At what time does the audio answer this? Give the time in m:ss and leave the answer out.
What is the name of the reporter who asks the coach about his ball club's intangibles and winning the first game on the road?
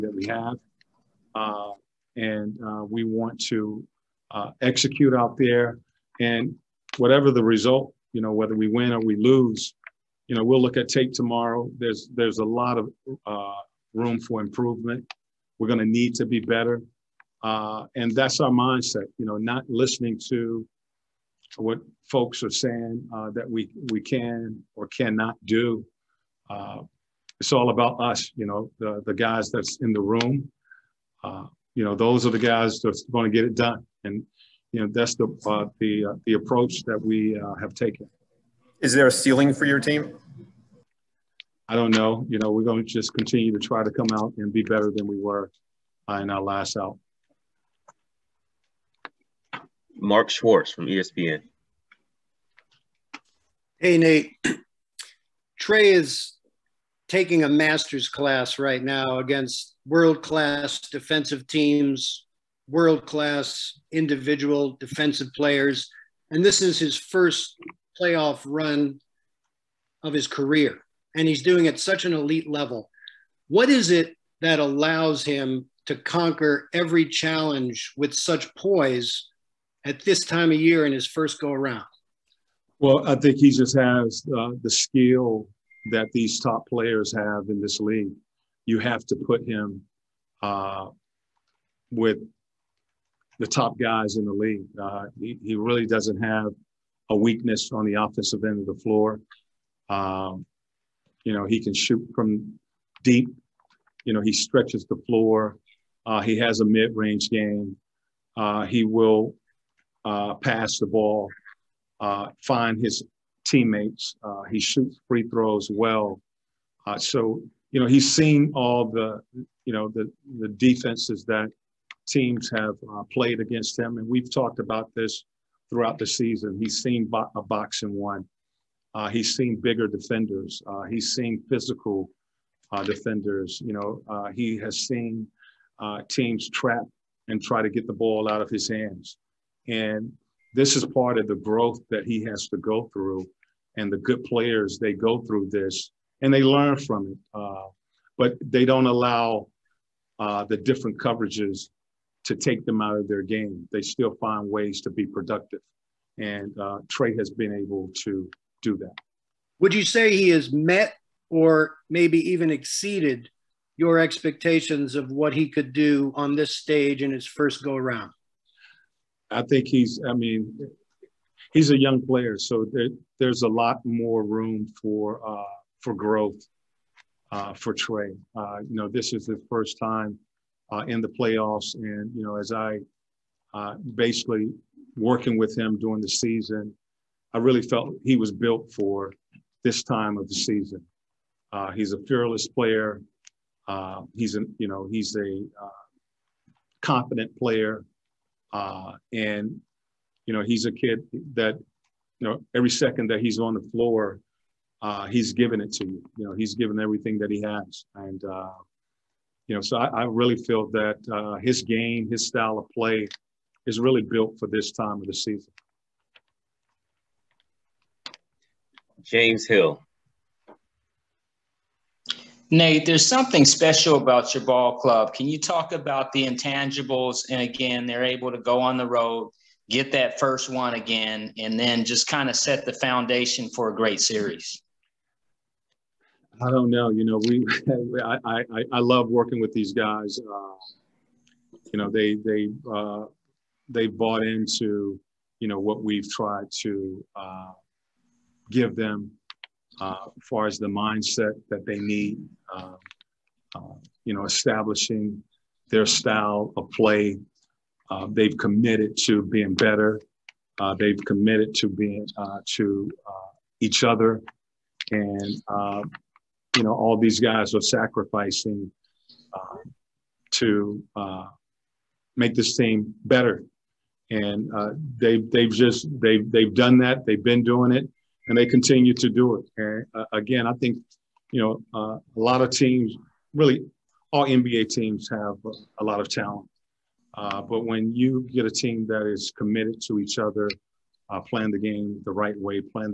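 3:39.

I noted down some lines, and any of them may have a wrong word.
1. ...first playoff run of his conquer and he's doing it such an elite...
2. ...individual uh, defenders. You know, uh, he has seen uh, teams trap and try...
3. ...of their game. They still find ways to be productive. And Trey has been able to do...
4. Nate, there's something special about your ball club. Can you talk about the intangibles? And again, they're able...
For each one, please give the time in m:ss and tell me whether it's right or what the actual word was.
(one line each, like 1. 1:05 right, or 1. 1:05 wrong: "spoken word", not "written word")
1. 1:06 wrong: "career", not "conquer"
2. 2:11 wrong: "physical", not "individual"
3. 2:32 right
4. 3:42 right.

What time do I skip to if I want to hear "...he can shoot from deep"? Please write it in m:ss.
1:41.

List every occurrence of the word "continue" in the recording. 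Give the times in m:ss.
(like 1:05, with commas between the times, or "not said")
0:43, 4:38.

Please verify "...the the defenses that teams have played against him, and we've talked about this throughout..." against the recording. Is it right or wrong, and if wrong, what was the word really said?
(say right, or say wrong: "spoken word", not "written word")
right.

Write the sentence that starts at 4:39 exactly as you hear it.
And uh, again, I think you know uh, a lot of teams, really all NBA teams, have a lot of talent.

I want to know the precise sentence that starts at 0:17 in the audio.
Uh, and that's our mindset, you know, not listening to what folks are saying uh, that we, we can or cannot do.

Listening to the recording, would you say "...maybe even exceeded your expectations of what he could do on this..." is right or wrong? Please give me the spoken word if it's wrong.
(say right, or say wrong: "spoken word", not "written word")
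right.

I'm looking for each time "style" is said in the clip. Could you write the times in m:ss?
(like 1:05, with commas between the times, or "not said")
3:32, 4:15.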